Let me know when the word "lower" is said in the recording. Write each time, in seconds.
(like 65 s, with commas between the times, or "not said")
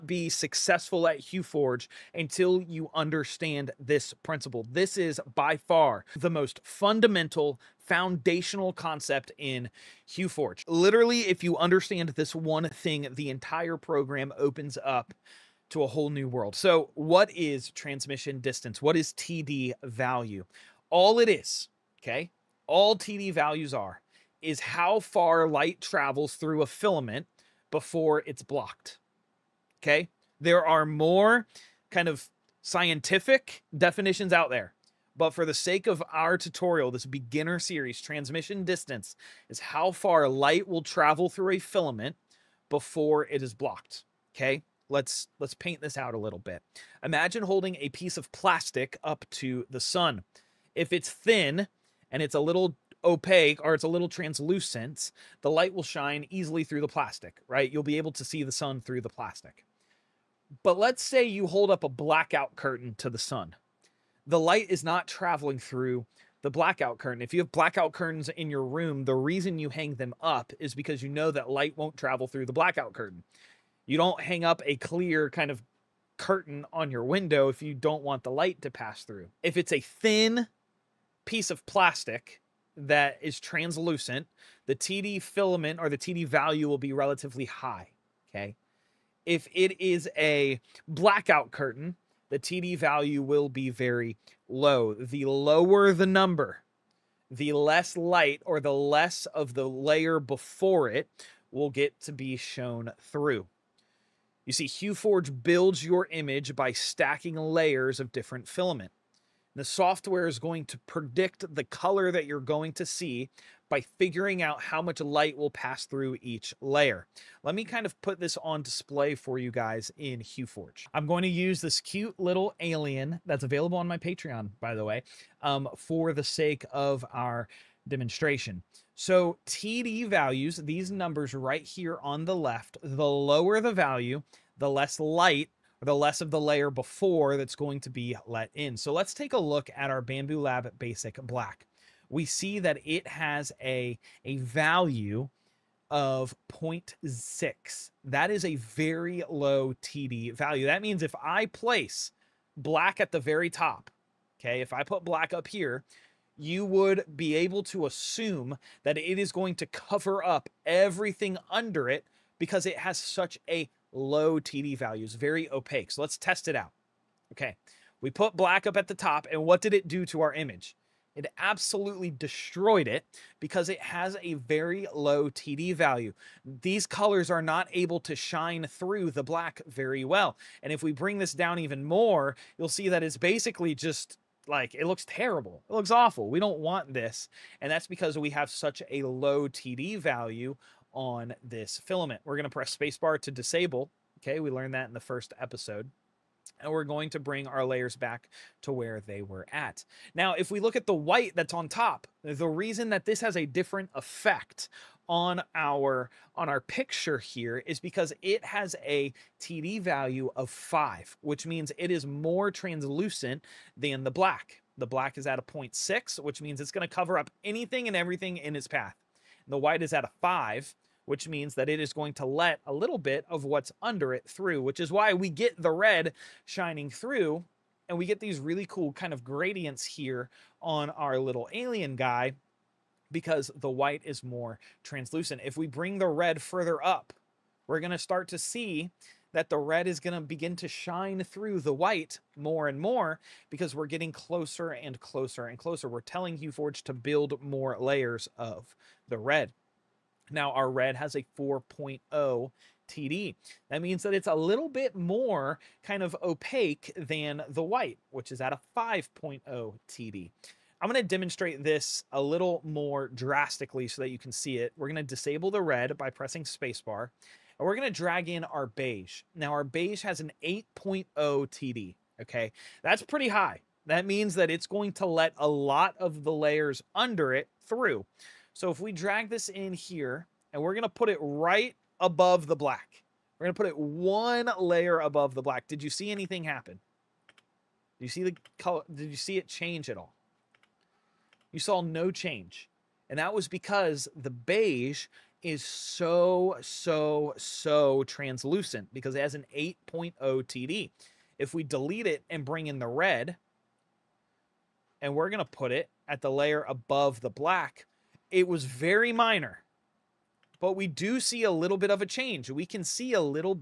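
95 s, 133 s.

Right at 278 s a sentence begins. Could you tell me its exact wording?
So if we drag this in here, and we're going to put it right above the black.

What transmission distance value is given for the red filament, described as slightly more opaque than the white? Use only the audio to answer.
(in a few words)
4.0.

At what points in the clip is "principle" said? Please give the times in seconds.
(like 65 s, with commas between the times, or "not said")
4 s.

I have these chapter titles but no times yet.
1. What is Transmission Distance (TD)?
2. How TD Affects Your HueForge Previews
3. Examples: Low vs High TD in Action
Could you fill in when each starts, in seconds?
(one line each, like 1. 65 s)
1. 9 s
2. 116 s
3. 234 s.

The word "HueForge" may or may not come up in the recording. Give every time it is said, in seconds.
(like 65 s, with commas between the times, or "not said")
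1 s, 10 s, 104 s, 120 s, 246 s.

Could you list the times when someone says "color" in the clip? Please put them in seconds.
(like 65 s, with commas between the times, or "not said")
111 s, 176 s, 288 s.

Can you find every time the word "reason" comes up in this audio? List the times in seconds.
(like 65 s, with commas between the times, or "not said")
69 s, 202 s.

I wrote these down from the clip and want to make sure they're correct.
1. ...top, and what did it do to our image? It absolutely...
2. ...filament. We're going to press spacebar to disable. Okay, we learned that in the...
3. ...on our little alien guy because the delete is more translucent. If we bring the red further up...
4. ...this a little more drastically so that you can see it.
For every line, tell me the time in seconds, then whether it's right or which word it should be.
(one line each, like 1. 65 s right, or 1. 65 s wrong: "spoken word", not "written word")
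1. 168 s right
2. 191 s right
3. 230 s wrong: "white", not "delete"
4. 261 s right.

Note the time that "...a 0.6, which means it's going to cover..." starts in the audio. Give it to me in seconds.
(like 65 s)
215 s.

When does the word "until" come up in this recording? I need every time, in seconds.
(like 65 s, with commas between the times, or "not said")
2 s.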